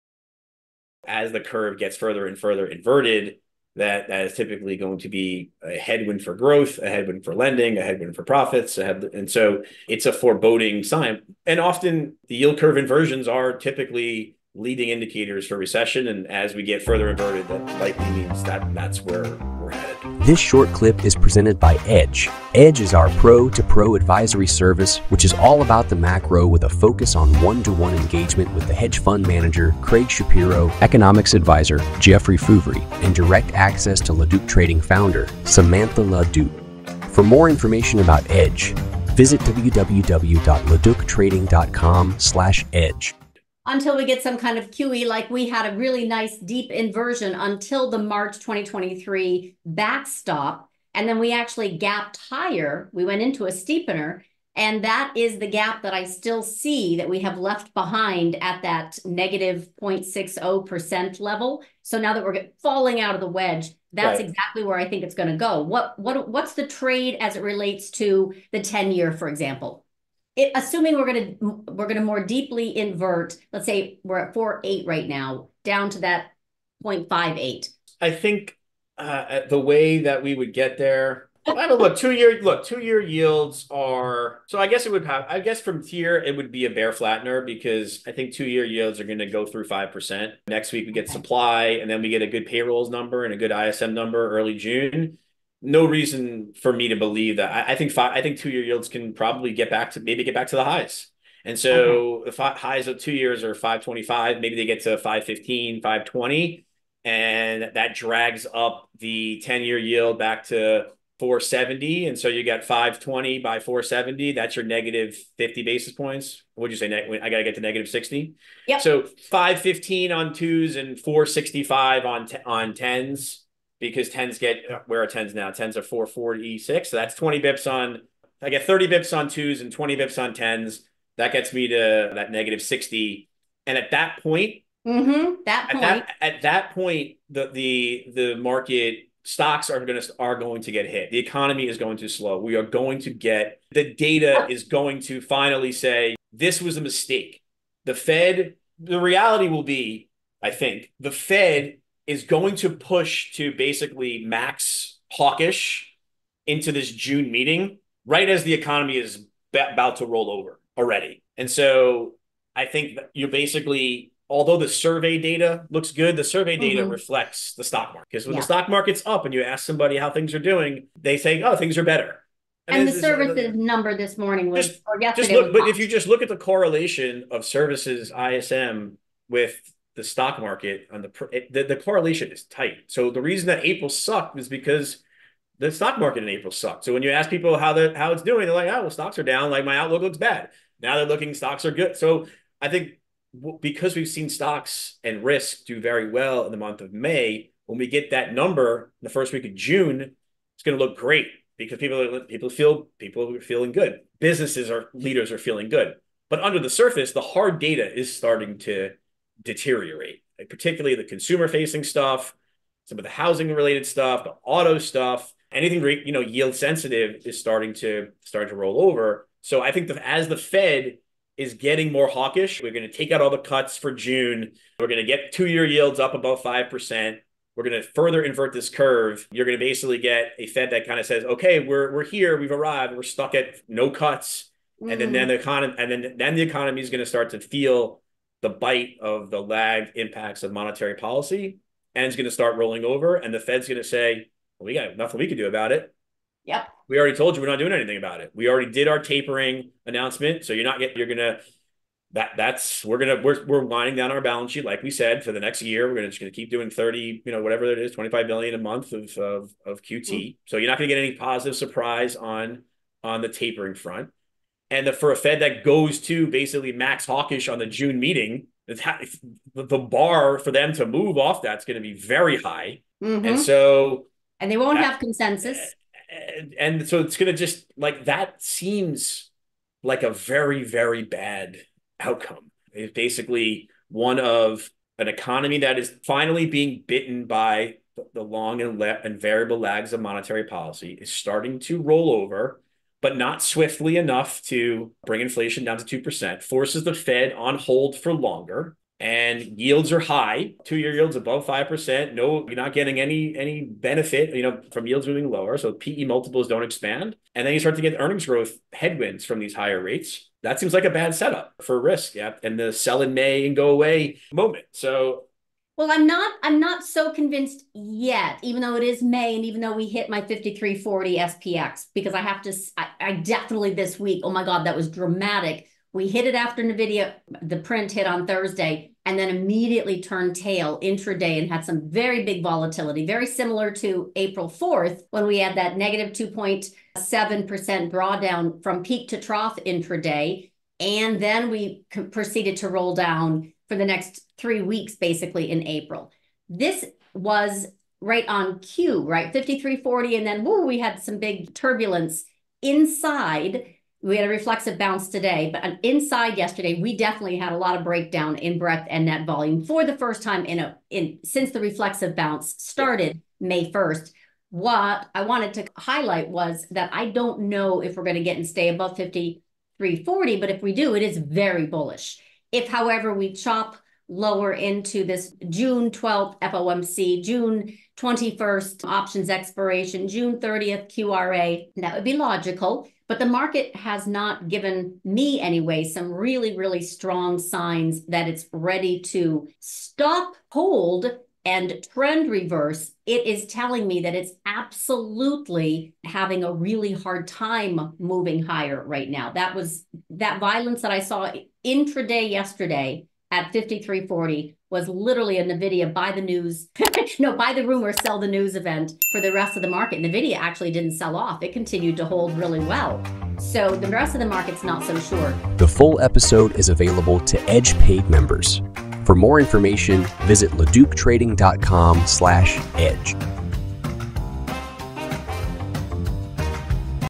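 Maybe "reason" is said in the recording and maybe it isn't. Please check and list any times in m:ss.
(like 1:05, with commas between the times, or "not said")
1:35, 3:03.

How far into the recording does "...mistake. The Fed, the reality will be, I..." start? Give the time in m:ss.
2:26.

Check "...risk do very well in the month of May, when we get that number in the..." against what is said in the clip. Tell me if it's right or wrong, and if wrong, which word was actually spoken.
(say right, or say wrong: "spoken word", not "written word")
right.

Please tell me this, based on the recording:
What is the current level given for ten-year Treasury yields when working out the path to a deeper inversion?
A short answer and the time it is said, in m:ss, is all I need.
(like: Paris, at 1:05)
4.46%, at 2:05.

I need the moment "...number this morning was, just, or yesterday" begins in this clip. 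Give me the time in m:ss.
2:53.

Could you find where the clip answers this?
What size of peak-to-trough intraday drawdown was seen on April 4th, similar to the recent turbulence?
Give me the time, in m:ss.
5:35.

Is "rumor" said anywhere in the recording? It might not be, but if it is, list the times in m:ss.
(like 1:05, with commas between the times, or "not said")
6:47.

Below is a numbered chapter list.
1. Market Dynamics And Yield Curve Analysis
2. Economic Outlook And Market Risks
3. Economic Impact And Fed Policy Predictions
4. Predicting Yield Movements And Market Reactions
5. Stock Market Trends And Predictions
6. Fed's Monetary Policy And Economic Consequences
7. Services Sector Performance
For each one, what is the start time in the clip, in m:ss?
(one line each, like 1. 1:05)
1. 0:42
2. 4:57
3. 2:20
4. 1:16
5. 5:45
6. 4:08
7. 3:06.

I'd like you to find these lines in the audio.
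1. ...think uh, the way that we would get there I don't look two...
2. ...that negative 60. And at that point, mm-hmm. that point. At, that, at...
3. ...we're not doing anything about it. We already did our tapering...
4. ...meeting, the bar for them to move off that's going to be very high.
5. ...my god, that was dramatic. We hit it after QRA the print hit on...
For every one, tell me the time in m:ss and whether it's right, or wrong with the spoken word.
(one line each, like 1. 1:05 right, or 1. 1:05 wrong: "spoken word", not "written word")
1. 1:18 right
2. 2:12 right
3. 4:07 right
4. 4:27 right
5. 5:24 wrong: "Nvidia", not "QRA".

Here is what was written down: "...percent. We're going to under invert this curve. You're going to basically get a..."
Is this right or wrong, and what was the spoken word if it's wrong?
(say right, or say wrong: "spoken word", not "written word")
wrong: "further", not "under".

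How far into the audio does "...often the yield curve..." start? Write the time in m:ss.
0:11.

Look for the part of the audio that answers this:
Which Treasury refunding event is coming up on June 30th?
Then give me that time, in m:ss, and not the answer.
6:20.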